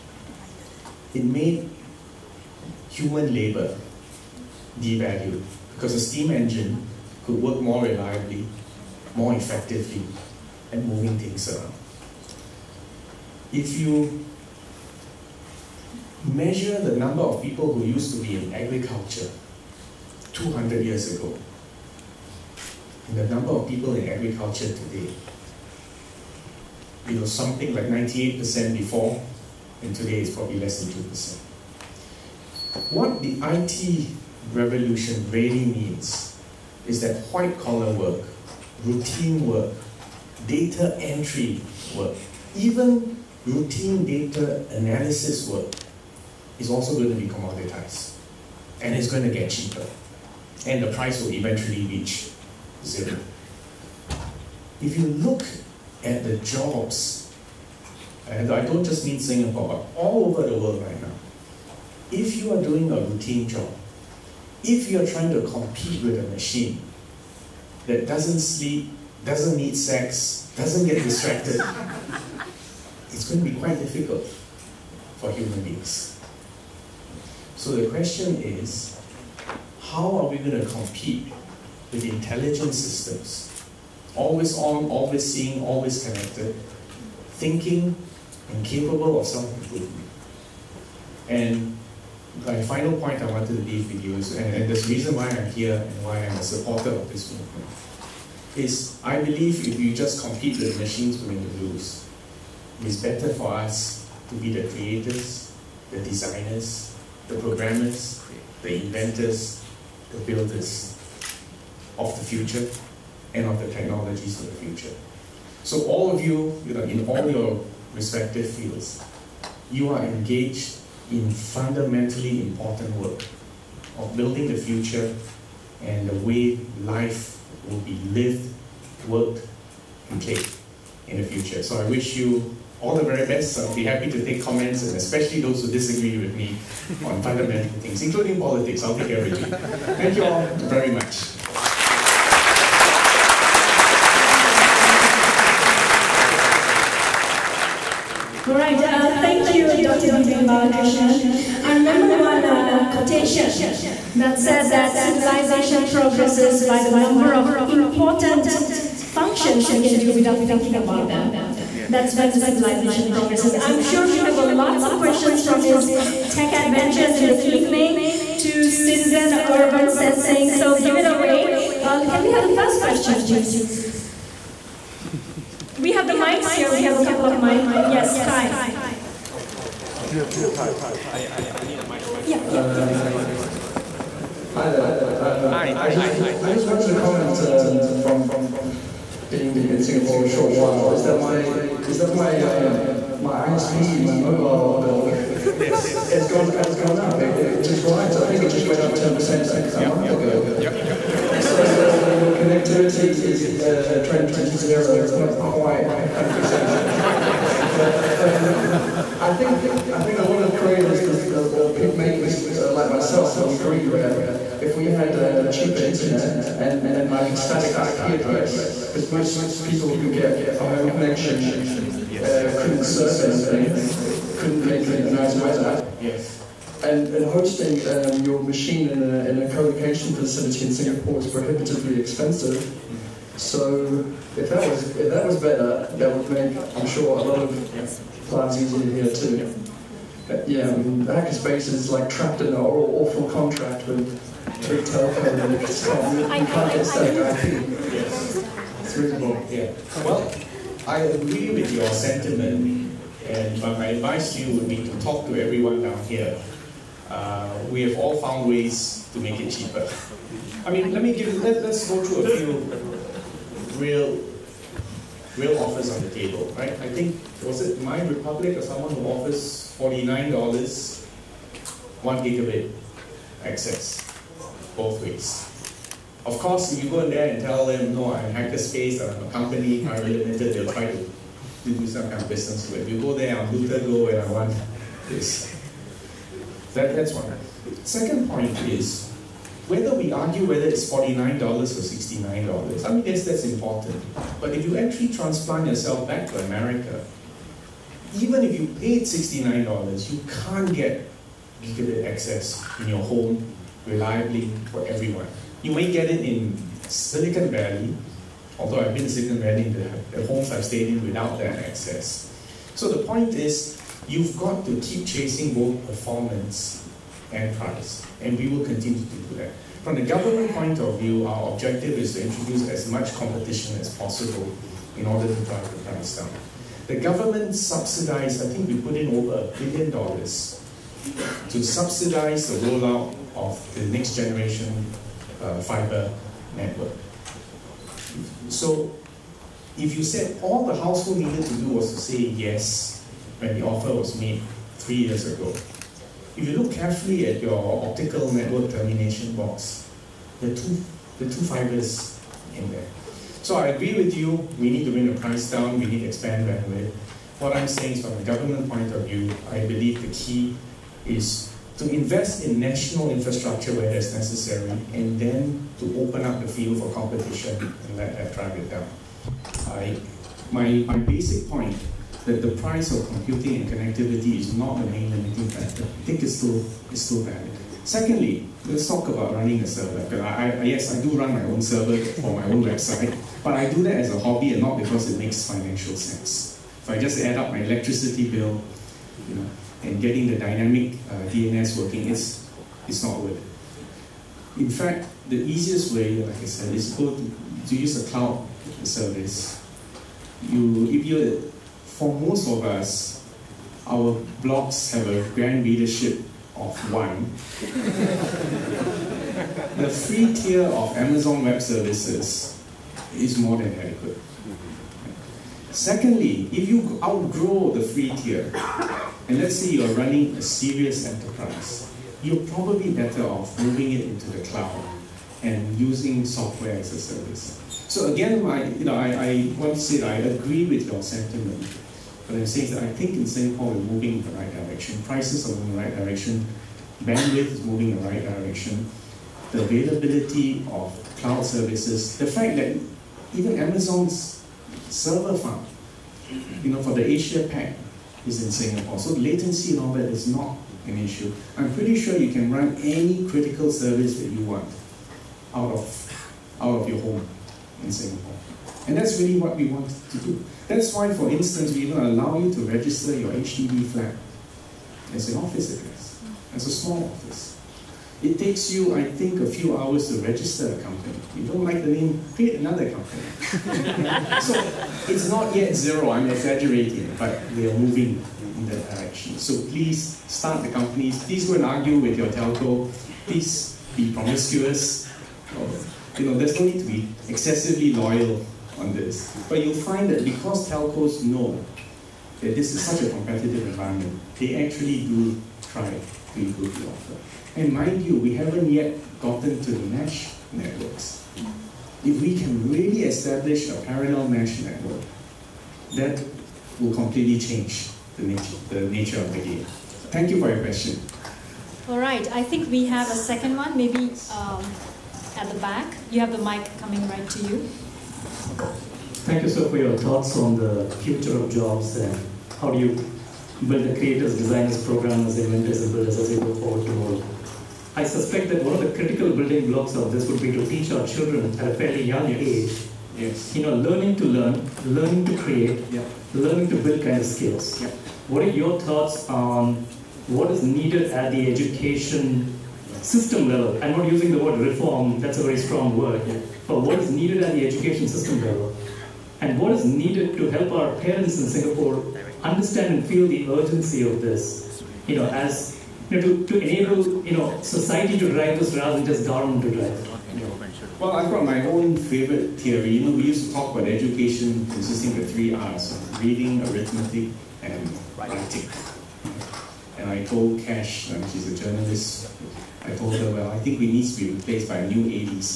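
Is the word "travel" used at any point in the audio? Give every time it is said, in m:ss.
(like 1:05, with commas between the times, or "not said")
not said.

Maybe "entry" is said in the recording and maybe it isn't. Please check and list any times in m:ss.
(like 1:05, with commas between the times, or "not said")
0:40.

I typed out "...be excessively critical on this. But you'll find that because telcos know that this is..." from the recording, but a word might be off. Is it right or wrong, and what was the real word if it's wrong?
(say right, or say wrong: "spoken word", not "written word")
wrong: "loyal", not "critical".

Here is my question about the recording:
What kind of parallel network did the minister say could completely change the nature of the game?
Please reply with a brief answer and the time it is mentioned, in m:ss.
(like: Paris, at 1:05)
mesh network, at 8:24.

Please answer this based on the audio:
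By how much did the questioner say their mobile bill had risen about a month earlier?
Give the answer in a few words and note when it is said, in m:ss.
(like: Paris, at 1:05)
10%, at 3:18.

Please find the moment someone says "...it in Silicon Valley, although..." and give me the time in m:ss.
5:06.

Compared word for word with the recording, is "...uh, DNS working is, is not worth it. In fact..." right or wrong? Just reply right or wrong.
right.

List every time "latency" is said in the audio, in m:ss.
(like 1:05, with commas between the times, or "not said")
7:29.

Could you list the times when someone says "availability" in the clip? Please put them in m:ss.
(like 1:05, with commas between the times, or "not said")
7:19.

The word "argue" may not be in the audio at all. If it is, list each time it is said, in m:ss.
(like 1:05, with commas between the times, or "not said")
4:50, 8:01.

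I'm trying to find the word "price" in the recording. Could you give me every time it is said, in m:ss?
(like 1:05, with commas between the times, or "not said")
0:50, 5:17, 5:25, 5:55, 6:12, 7:15.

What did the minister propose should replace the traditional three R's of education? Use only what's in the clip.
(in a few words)
a new ABC.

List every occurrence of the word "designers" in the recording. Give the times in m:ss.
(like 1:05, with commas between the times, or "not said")
1:46, 8:44.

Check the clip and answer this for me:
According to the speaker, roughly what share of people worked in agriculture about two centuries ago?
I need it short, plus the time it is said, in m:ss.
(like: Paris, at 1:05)
98%, at 0:27.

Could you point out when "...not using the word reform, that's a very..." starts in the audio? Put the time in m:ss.
9:03.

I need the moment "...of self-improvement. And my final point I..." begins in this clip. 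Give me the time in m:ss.
1:29.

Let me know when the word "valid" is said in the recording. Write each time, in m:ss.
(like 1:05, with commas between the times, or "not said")
6:17.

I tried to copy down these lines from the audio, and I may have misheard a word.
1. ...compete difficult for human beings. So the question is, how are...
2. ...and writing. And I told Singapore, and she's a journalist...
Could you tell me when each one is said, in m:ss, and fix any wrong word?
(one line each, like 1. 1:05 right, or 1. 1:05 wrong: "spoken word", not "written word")
1. 1:13 wrong: "quite", not "compete"
2. 9:27 wrong: "Cash", not "Singapore".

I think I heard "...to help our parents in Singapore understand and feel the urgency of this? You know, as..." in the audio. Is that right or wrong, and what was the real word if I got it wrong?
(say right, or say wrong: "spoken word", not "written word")
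right.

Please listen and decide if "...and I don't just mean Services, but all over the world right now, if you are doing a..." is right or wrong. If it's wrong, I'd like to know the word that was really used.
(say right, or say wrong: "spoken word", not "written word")
wrong: "Singapore", not "Services".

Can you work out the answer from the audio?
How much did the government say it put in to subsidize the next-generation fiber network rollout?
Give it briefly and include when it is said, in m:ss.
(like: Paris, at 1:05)
over a billion dollars, at 5:29.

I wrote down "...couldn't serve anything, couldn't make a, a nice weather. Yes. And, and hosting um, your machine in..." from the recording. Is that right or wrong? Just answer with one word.
right.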